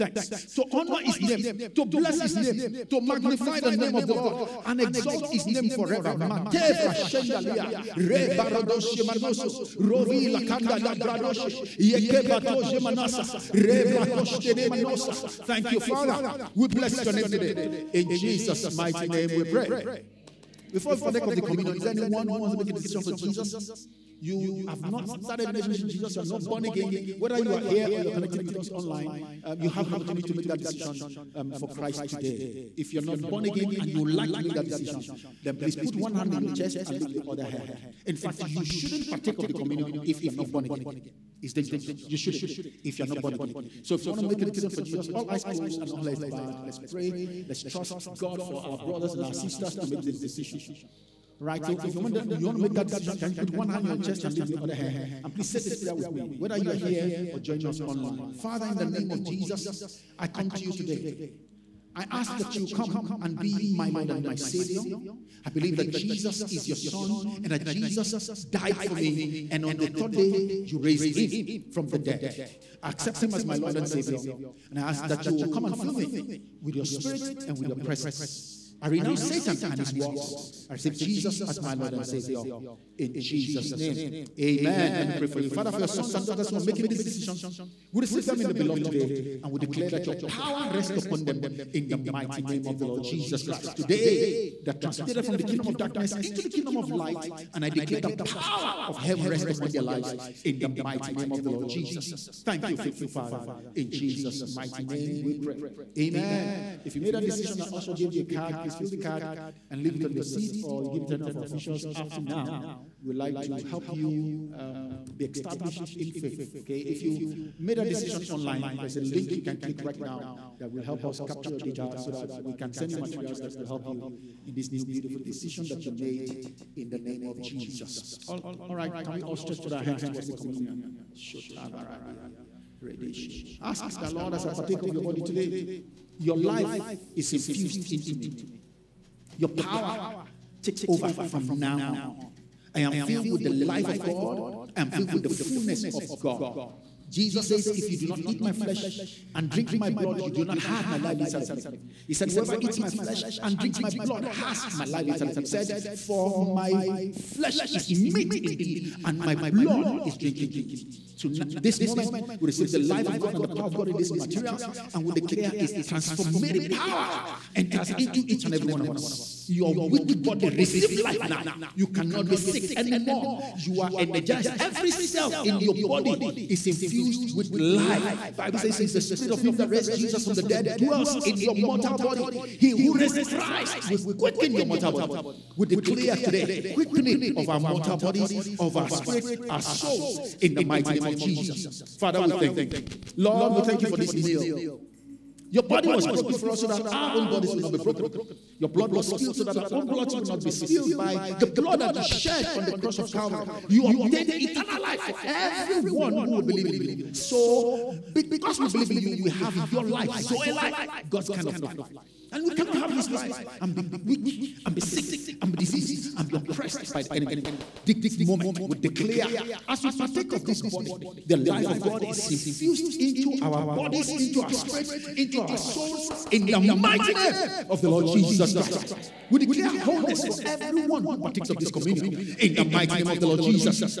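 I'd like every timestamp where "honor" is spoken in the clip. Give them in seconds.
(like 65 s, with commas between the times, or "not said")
0 s.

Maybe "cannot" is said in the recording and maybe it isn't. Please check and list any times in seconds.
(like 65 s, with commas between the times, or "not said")
171 s, 212 s.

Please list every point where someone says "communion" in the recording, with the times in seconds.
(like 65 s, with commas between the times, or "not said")
21 s, 39 s, 130 s, 231 s.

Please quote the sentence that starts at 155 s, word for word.
He said, For my flesh is meat indeed, and my blood is drink indeed.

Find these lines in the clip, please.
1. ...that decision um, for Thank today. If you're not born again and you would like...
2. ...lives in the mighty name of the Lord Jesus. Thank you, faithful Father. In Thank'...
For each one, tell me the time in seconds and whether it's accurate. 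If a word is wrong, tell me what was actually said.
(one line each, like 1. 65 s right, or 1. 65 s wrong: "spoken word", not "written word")
1. 30 s wrong: "Christ", not "Thank"
2. 99 s wrong: "Jesus", not "Thank".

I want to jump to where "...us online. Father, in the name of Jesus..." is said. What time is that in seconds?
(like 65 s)
57 s.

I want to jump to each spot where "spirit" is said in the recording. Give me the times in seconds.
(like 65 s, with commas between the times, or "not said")
76 s, 179 s, 188 s, 224 s.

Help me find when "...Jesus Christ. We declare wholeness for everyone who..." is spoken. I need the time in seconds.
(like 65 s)
228 s.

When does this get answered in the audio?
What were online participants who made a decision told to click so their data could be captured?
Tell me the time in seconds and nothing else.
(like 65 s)
119 s.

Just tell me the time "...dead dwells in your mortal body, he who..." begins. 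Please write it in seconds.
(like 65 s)
180 s.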